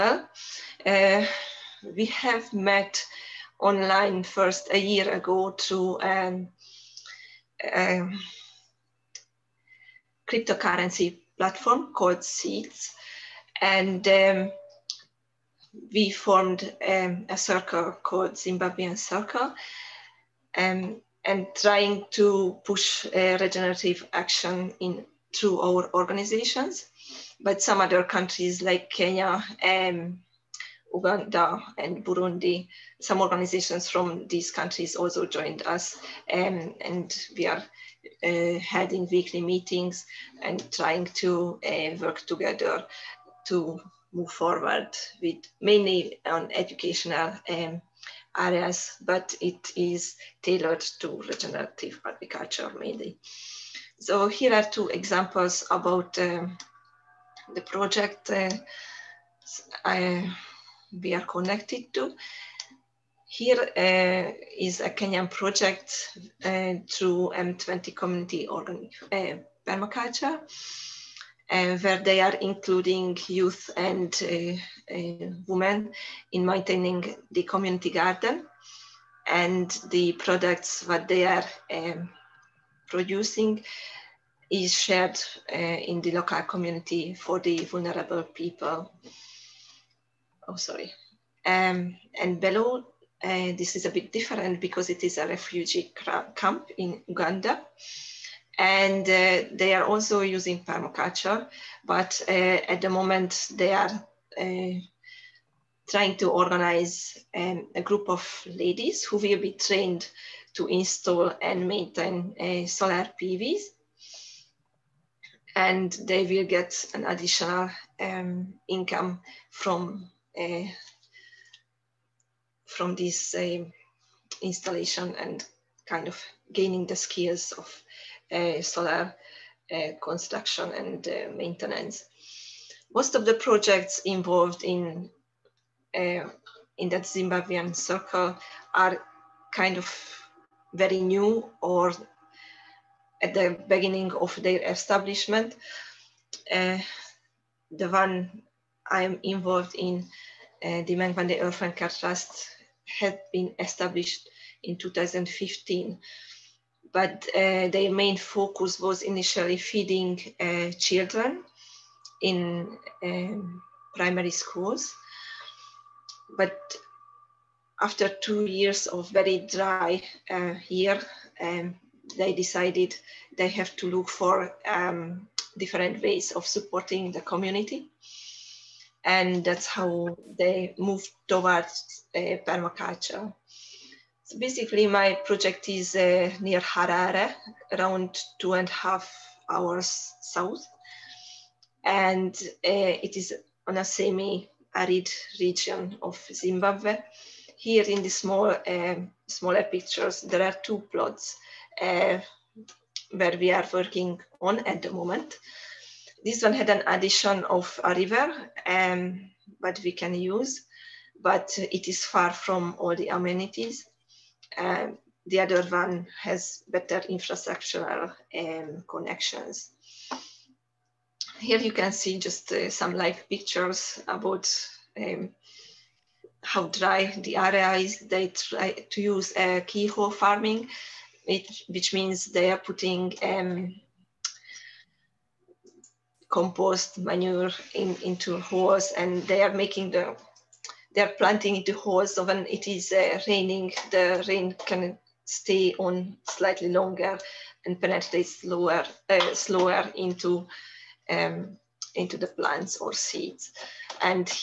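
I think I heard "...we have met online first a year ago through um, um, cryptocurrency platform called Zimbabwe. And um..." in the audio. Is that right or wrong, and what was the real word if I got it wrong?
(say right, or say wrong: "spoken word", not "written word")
wrong: "Seeds", not "Zimbabwe".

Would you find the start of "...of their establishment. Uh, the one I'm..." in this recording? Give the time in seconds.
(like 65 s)
144 s.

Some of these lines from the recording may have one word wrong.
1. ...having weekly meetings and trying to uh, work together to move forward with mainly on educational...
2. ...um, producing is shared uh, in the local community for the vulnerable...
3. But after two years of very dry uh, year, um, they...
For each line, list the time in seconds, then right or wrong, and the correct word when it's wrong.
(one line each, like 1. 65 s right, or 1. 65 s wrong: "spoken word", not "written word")
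1. 38 s right
2. 81 s right
3. 166 s right.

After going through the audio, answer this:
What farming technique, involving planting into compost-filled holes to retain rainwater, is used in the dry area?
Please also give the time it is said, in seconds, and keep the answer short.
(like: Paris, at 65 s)
keyhole farming, at 229 s.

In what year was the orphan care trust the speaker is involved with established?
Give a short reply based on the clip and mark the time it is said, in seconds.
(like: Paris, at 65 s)
2015, at 154 s.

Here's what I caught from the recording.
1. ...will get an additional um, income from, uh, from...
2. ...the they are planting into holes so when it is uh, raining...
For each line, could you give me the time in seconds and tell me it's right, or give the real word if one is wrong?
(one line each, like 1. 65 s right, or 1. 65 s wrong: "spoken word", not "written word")
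1. 116 s right
2. 239 s right.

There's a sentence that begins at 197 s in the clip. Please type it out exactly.
Here in the small, eh, smaller pictures, there are two plots eh, where we are working on at the moment.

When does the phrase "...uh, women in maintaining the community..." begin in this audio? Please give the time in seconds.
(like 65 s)
74 s.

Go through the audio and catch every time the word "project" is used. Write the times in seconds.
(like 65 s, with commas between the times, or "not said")
57 s, 65 s, 133 s, 185 s.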